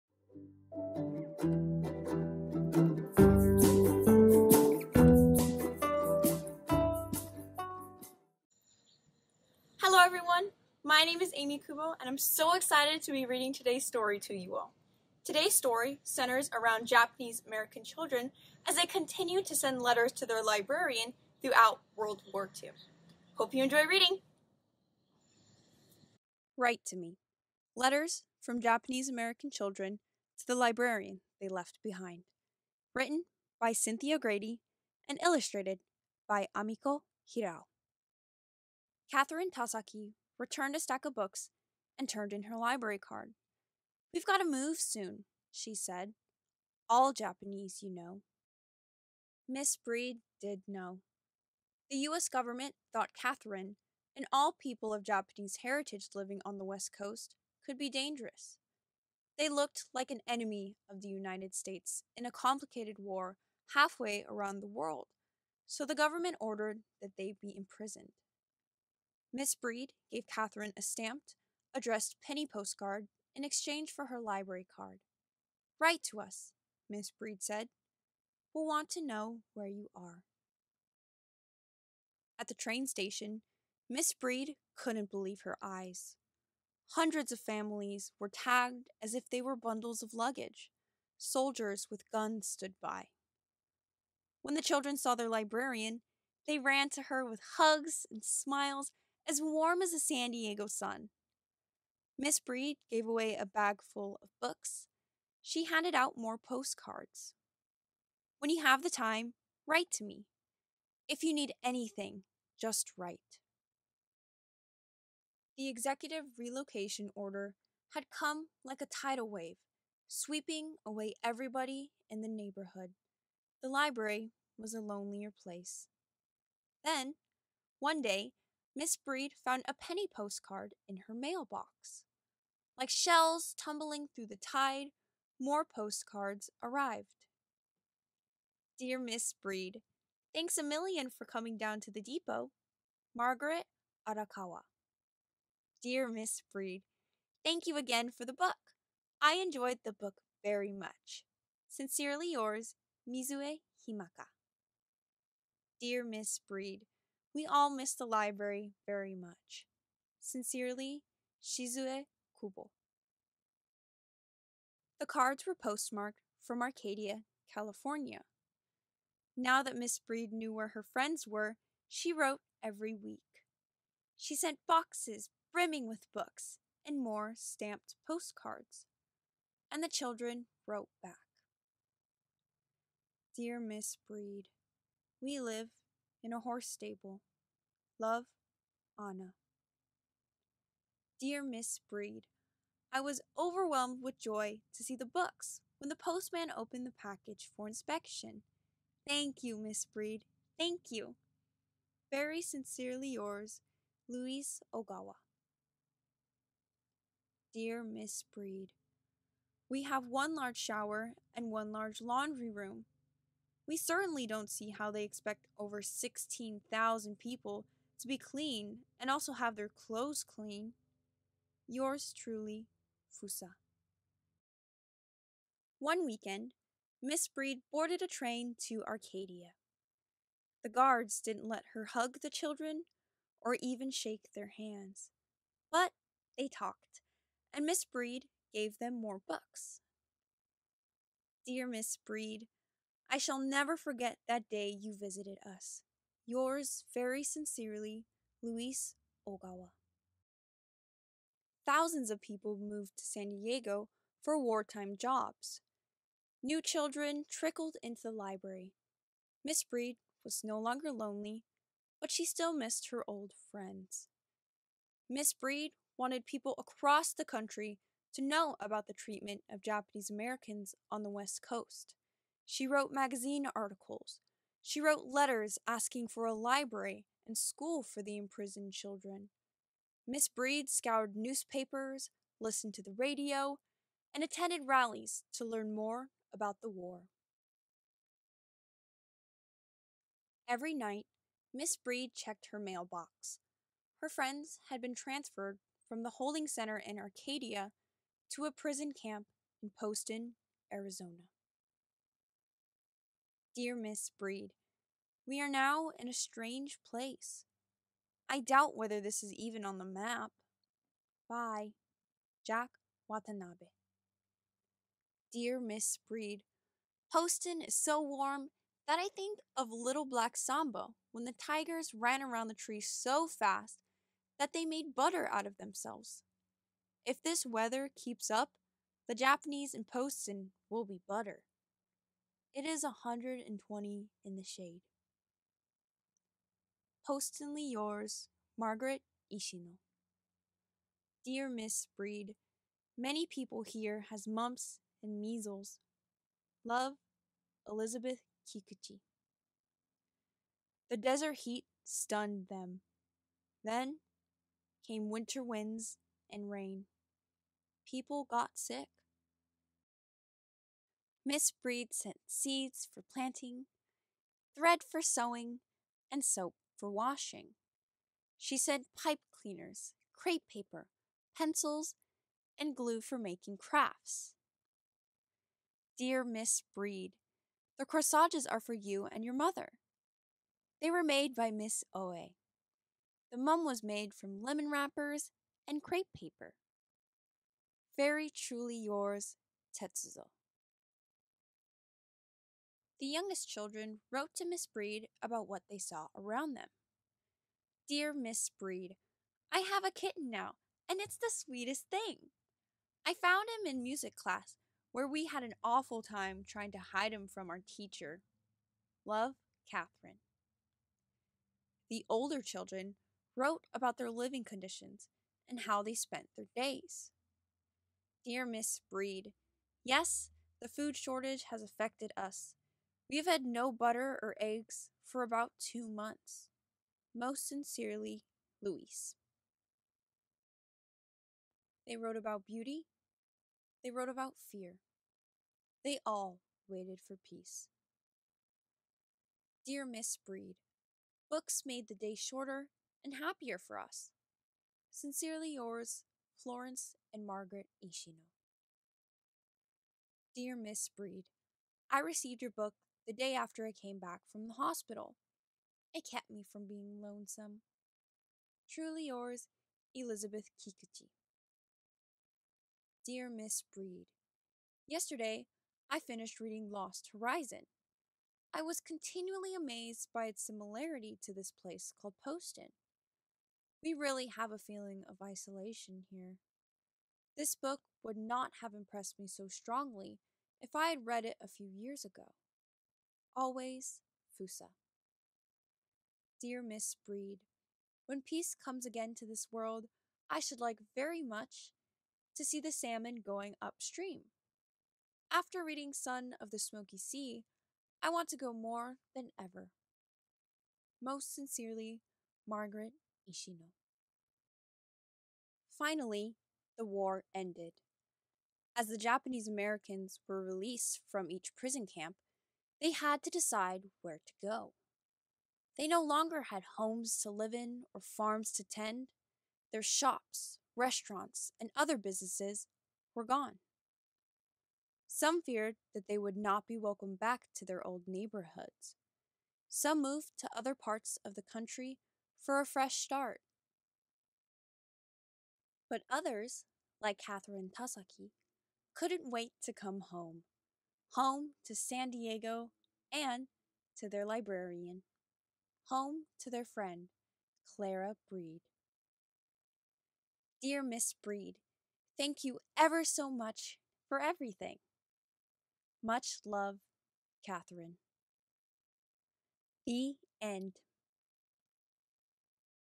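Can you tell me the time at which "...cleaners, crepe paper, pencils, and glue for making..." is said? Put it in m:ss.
6:09.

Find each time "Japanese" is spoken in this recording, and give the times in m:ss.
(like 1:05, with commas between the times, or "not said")
0:16, 0:28, 0:47, 0:55, 4:29, 5:29, 8:28.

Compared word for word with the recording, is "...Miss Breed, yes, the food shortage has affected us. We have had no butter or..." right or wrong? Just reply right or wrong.
right.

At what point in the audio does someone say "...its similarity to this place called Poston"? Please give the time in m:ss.
7:50.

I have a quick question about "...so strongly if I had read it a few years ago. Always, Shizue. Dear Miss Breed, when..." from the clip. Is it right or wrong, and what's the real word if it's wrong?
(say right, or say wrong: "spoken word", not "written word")
wrong: "Fusa", not "Shizue".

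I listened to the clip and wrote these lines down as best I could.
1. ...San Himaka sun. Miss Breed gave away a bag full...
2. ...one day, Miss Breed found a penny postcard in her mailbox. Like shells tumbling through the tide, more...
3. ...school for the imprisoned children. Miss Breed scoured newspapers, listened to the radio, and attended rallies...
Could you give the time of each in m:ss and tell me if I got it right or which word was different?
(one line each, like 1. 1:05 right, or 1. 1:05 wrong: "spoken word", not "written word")
1. 1:39 wrong: "Diego", not "Himaka"
2. 2:07 right
3. 4:37 right.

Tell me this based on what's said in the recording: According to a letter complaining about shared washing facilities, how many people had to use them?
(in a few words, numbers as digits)
16,000.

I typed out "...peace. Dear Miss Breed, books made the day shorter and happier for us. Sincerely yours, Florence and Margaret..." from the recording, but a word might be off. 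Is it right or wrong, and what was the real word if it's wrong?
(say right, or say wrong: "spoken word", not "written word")
right.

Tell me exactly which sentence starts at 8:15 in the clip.
After reading Son of the Smoky Sea, I want to go more than ever.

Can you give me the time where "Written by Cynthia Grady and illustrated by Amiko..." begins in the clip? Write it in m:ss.
0:32.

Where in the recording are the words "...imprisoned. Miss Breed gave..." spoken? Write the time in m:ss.
1:07.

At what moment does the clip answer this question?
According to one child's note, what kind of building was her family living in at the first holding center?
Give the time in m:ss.
3:06.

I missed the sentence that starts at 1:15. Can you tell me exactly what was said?
Write to us, Miss Breed said.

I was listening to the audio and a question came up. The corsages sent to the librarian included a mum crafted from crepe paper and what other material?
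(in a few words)
lemon wrappers.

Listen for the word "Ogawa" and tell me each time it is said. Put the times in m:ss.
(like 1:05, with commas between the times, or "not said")
3:24, 4:09.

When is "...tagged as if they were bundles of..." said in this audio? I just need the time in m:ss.
1:28.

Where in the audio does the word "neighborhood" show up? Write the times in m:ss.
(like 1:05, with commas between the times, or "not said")
2:02, 8:48.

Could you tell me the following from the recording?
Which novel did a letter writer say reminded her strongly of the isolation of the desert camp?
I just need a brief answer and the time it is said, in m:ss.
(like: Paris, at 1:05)
Lost Horizon, at 7:46.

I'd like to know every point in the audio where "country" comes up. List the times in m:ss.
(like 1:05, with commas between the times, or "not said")
4:27, 8:51.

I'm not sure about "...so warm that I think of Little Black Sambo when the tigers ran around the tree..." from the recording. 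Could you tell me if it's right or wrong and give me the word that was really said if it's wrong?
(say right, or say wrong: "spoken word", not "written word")
right.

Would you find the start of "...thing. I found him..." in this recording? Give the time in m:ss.
6:41.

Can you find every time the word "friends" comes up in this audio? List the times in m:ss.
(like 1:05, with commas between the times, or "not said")
2:50, 4:23, 4:54, 9:06.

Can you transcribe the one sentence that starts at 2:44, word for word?
The cards were postmarked from Arcadia, California.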